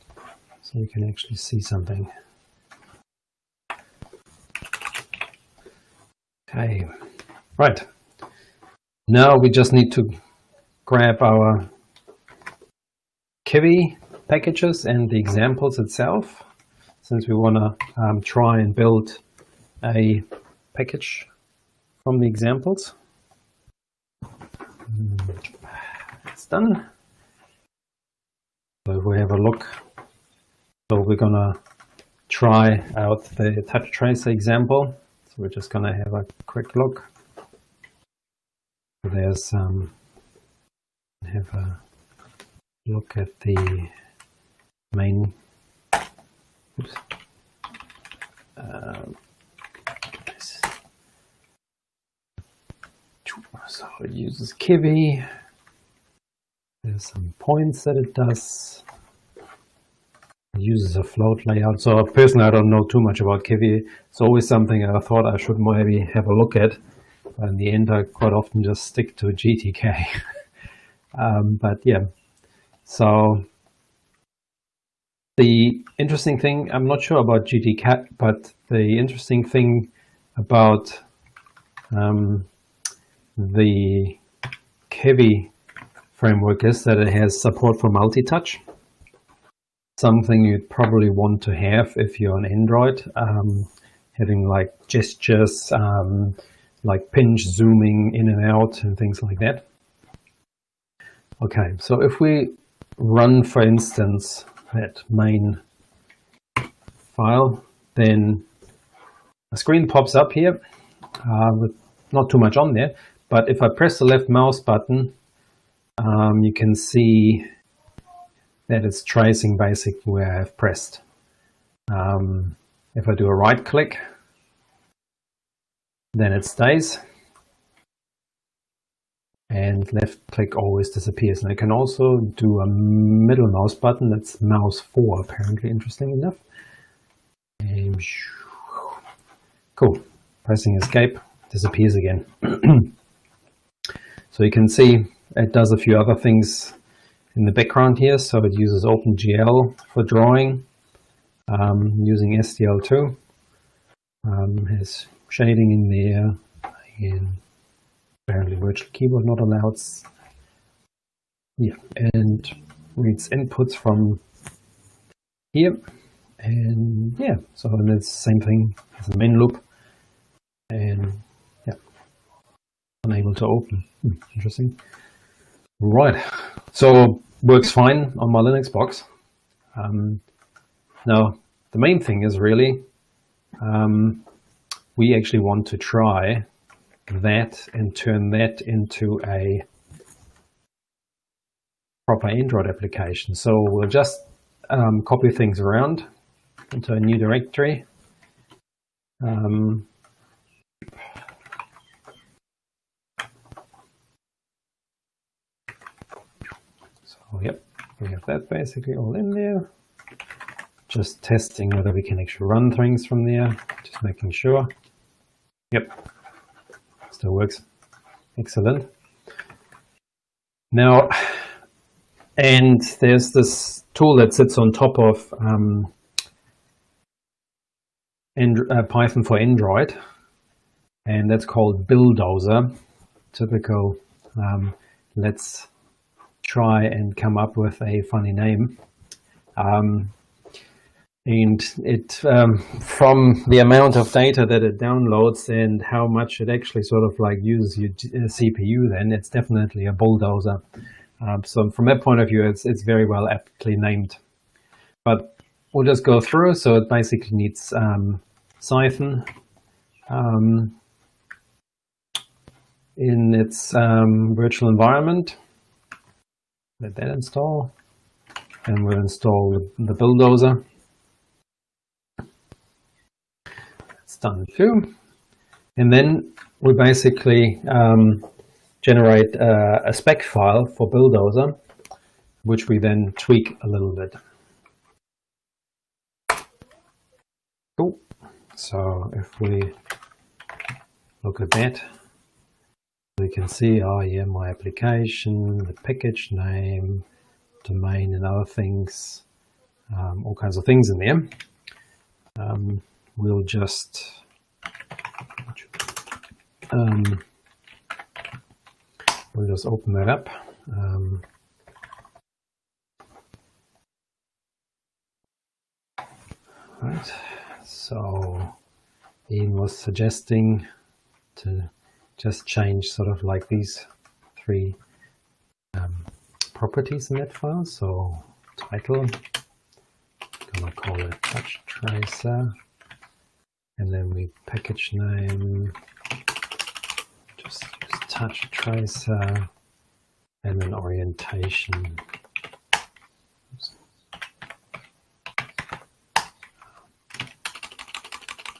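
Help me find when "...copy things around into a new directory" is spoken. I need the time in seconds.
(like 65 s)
195 s.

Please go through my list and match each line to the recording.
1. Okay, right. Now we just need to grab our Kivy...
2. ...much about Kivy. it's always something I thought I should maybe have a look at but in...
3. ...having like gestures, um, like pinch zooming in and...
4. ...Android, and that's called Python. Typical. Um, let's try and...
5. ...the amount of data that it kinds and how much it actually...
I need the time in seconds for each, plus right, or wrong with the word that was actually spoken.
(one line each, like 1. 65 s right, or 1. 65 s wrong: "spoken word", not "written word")
1. 6 s right
2. 63 s right
3. 94 s right
4. 229 s wrong: "Buildozer", not "Python"
5. 243 s wrong: "downloads", not "kinds".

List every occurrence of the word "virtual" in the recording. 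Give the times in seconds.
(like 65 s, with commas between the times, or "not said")
158 s, 264 s.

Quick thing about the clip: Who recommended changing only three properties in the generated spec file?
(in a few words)
Ian.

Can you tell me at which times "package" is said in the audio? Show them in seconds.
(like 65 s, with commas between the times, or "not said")
14 s, 20 s, 295 s, 334 s.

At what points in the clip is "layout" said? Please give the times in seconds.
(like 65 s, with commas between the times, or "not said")
61 s.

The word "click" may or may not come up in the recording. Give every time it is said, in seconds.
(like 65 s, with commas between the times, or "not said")
123 s, 130 s.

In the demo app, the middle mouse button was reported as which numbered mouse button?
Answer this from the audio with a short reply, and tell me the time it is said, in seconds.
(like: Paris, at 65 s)
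mouse 4, at 134 s.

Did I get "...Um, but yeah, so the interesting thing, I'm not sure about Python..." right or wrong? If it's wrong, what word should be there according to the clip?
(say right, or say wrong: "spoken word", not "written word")
wrong: "GTK", not "Python".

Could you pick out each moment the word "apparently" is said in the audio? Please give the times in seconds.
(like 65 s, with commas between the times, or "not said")
135 s, 158 s.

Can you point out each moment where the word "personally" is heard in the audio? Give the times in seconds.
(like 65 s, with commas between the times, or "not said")
62 s.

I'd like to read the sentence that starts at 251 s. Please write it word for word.
Um, so from that point of view, it's it's very well aptly named.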